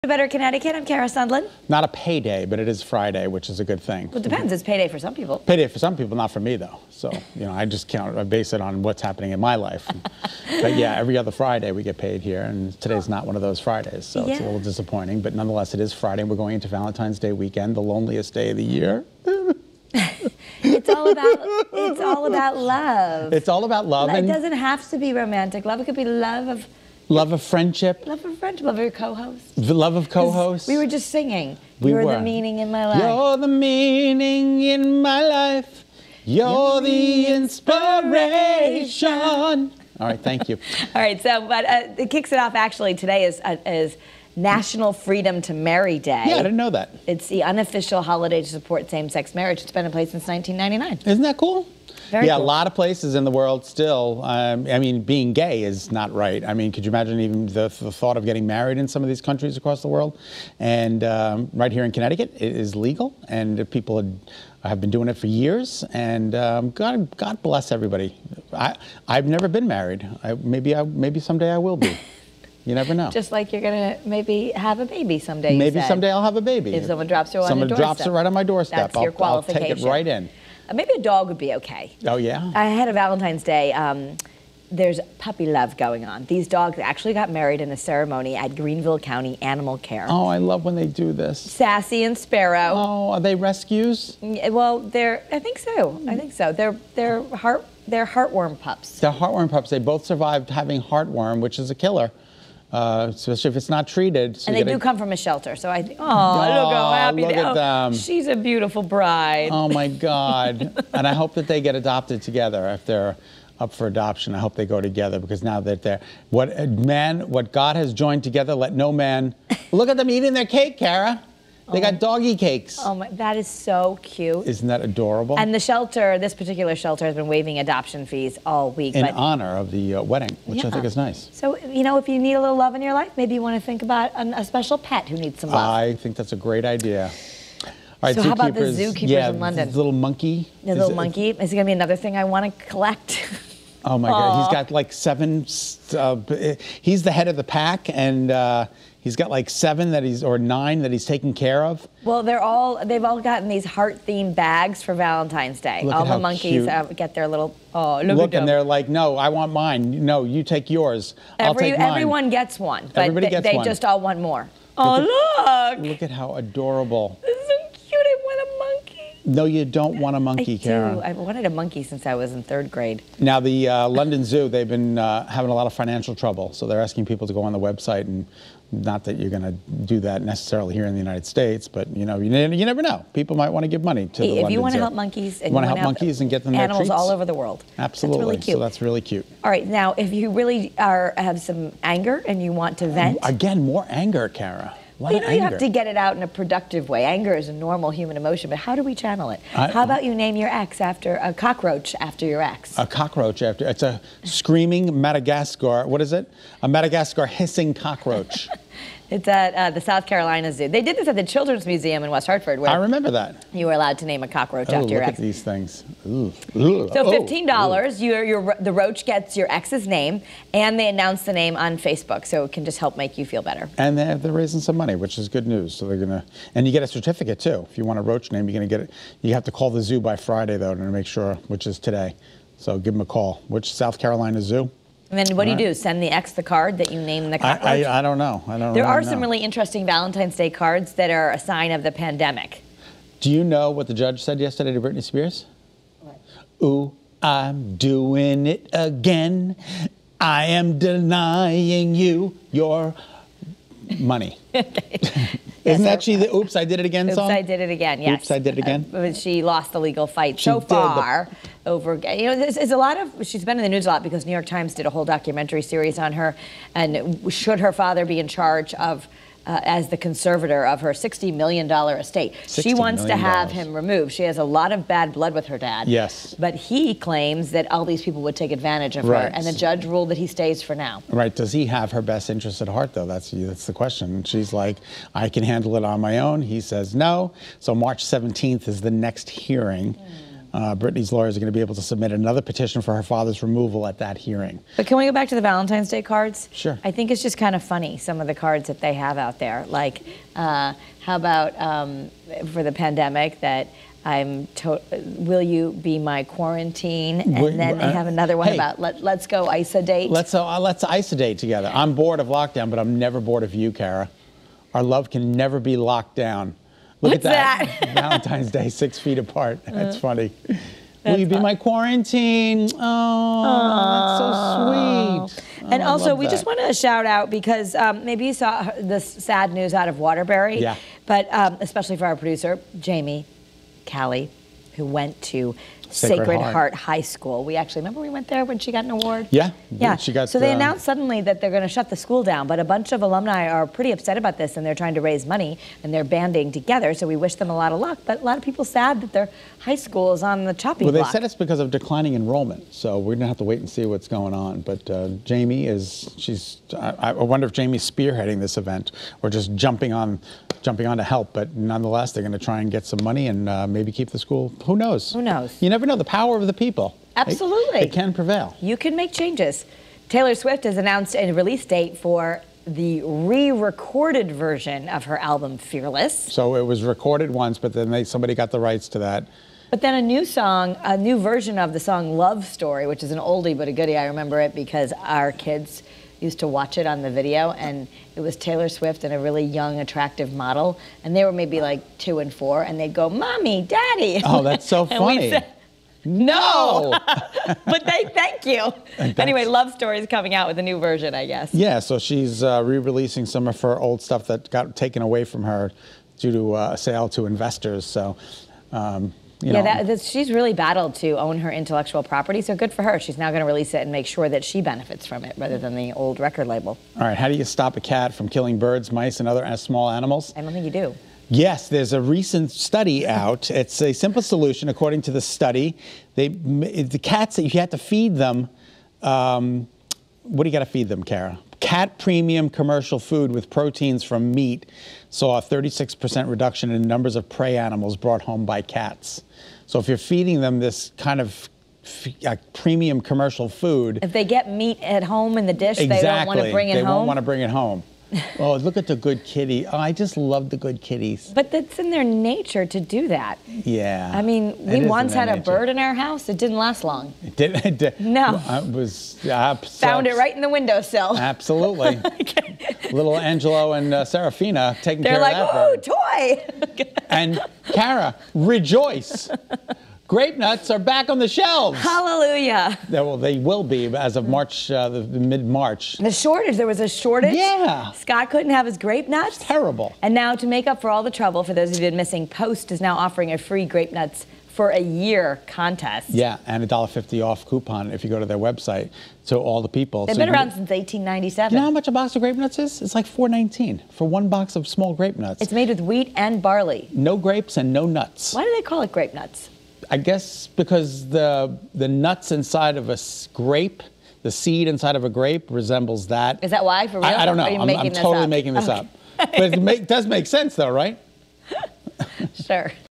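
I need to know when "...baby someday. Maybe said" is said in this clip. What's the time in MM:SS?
01:14.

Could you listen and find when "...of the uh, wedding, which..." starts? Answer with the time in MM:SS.
02:09.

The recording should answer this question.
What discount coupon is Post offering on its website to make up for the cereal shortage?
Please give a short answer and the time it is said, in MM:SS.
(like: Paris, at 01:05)
$1.50 off, at 08:06.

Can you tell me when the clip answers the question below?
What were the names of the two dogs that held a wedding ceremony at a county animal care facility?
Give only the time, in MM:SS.
01:31.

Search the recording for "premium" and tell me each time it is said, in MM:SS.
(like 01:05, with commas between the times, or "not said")
07:11, 07:22.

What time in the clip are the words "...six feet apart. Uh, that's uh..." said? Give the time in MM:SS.
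05:18.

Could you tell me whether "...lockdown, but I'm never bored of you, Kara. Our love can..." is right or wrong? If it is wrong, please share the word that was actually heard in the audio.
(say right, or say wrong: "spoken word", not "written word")
right.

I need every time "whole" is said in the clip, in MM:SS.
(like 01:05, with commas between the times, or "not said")
04:24.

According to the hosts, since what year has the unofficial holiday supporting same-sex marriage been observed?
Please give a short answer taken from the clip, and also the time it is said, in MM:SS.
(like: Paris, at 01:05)
1999, at 00:50.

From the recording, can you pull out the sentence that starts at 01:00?
And um, right here in Connecticut, it is legal, and people have been doing it for years.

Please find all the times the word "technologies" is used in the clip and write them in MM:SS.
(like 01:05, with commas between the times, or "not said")
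not said.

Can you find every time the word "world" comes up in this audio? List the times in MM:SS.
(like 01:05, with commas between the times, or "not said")
00:53, 00:59, 03:07.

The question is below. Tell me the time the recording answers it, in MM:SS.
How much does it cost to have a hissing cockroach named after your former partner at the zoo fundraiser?
03:37.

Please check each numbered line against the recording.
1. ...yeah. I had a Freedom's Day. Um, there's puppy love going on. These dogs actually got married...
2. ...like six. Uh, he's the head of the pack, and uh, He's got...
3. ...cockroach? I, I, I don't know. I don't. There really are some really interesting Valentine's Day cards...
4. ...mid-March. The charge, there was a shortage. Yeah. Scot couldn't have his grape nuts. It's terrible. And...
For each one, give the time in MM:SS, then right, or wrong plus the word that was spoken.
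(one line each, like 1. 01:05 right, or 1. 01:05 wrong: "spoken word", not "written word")
1. 01:22 wrong: "Valentine", not "Freedom"
2. 02:24 wrong: "seven", not "six"
3. 03:57 right
4. 07:55 wrong: "shortage", not "charge".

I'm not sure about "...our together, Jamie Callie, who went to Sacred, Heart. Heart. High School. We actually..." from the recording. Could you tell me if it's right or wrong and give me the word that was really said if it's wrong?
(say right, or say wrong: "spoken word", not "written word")
wrong: "producer", not "together".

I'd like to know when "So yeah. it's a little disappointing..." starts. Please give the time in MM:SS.
00:14.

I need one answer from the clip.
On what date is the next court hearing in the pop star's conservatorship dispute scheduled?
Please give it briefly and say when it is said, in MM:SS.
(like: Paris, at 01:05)
March 17th, at 04:47.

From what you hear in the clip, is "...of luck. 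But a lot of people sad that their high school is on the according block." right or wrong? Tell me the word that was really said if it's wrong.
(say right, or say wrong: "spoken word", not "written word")
wrong: "chopping", not "according".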